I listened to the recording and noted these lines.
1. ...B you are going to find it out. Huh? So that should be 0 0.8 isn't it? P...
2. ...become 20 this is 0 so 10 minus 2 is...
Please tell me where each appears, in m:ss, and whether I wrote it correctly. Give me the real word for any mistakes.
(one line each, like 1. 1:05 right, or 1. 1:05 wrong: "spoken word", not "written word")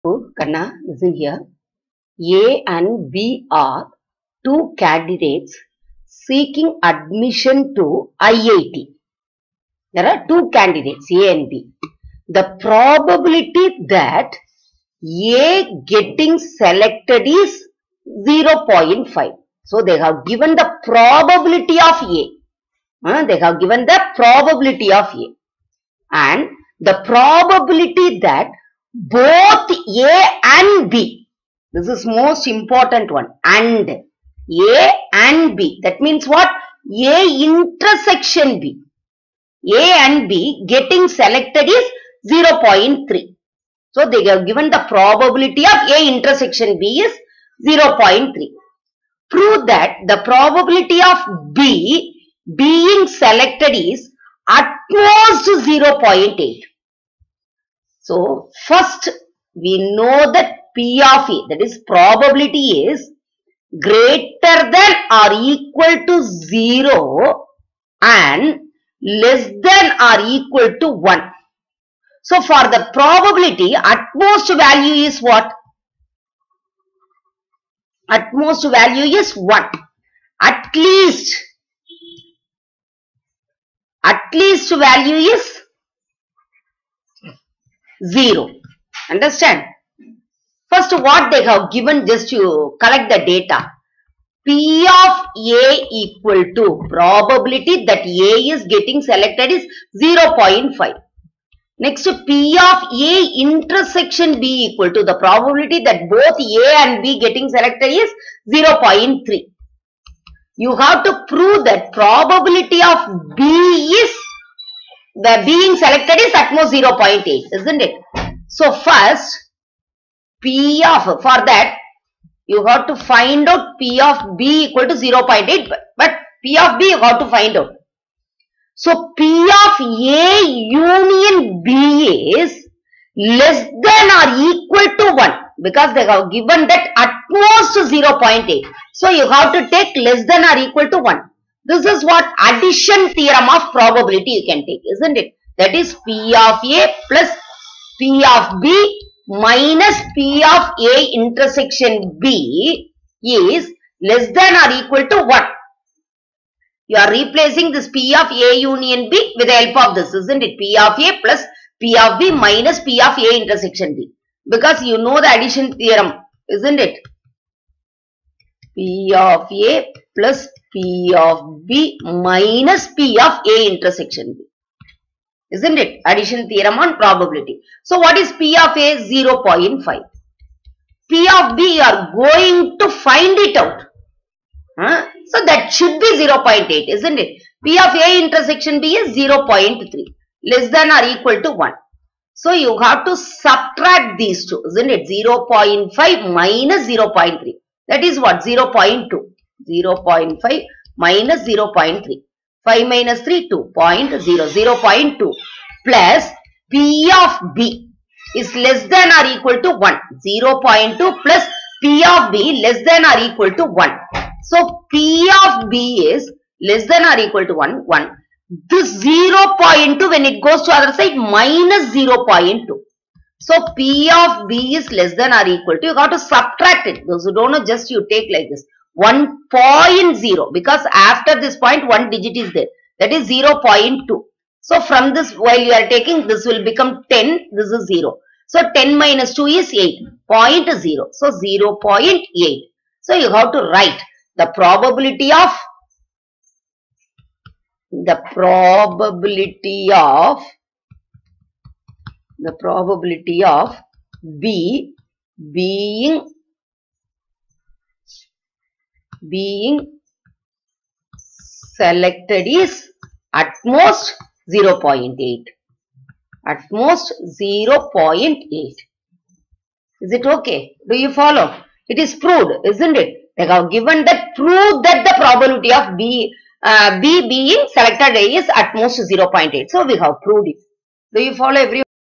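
1. 3:01 right
2. 3:56 wrong: "10", not "20".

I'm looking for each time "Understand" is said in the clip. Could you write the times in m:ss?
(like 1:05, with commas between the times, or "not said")
1:29.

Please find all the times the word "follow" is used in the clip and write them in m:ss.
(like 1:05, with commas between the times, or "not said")
4:31, 4:41.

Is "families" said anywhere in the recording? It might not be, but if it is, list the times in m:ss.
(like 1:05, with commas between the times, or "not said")
not said.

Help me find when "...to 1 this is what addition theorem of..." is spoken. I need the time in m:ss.
2:20.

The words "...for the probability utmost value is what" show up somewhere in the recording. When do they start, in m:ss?
1:12.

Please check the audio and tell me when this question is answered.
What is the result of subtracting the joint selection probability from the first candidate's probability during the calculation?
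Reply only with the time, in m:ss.
3:18.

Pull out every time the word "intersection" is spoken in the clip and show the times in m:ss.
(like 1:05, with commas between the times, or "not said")
0:37, 0:46, 1:43, 2:31, 2:43, 2:53, 3:08.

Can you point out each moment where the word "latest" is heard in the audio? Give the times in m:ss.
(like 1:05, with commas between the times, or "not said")
not said.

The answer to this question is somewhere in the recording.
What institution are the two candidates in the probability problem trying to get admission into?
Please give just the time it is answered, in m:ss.
0:08.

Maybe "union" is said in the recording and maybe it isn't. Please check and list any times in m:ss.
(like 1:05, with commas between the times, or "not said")
2:10, 2:38.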